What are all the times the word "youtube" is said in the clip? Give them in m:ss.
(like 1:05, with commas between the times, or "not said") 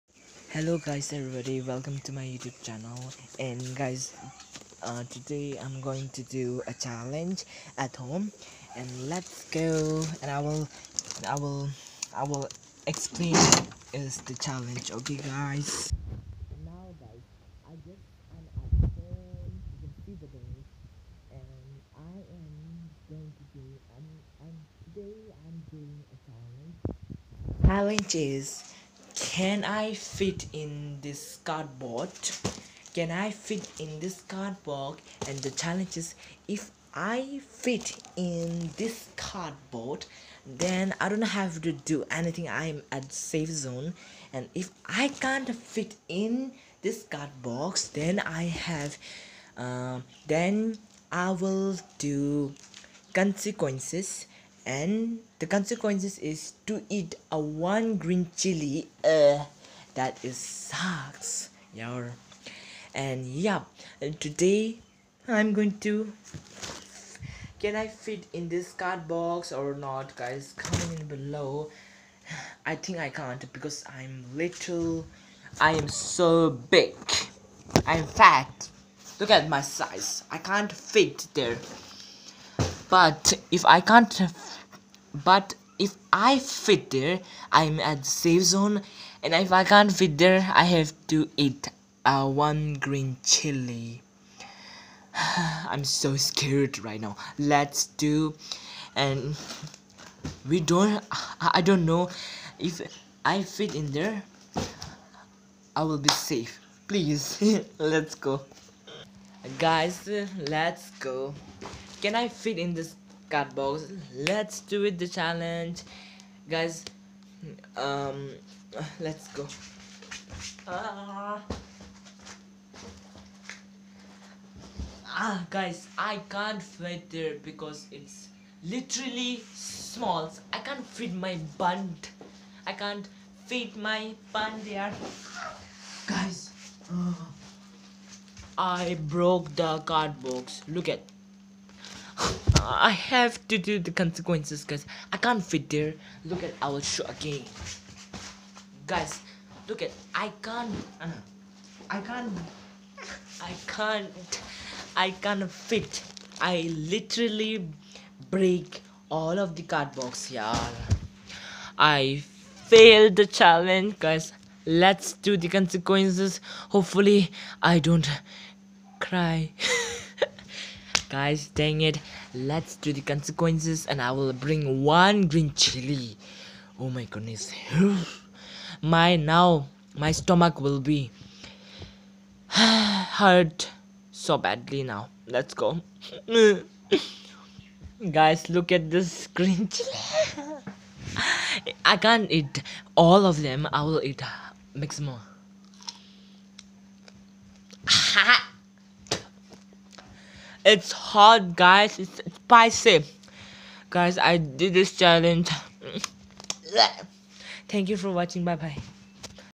0:02.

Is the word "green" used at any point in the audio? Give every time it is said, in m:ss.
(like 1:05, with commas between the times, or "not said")
0:57, 1:32, 2:55, 3:09.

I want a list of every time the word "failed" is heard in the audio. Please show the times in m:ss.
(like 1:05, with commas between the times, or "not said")
2:42.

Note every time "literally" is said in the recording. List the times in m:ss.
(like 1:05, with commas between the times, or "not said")
2:08, 2:36.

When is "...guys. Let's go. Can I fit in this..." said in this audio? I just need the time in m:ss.
1:49.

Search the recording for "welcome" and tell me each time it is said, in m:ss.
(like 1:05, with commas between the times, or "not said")
0:01.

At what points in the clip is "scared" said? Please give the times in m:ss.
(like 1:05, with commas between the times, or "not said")
1:36.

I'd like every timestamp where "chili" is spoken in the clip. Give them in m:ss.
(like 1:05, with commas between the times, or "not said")
0:58, 1:33, 2:55, 3:09.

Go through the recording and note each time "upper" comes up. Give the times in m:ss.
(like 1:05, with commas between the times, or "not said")
not said.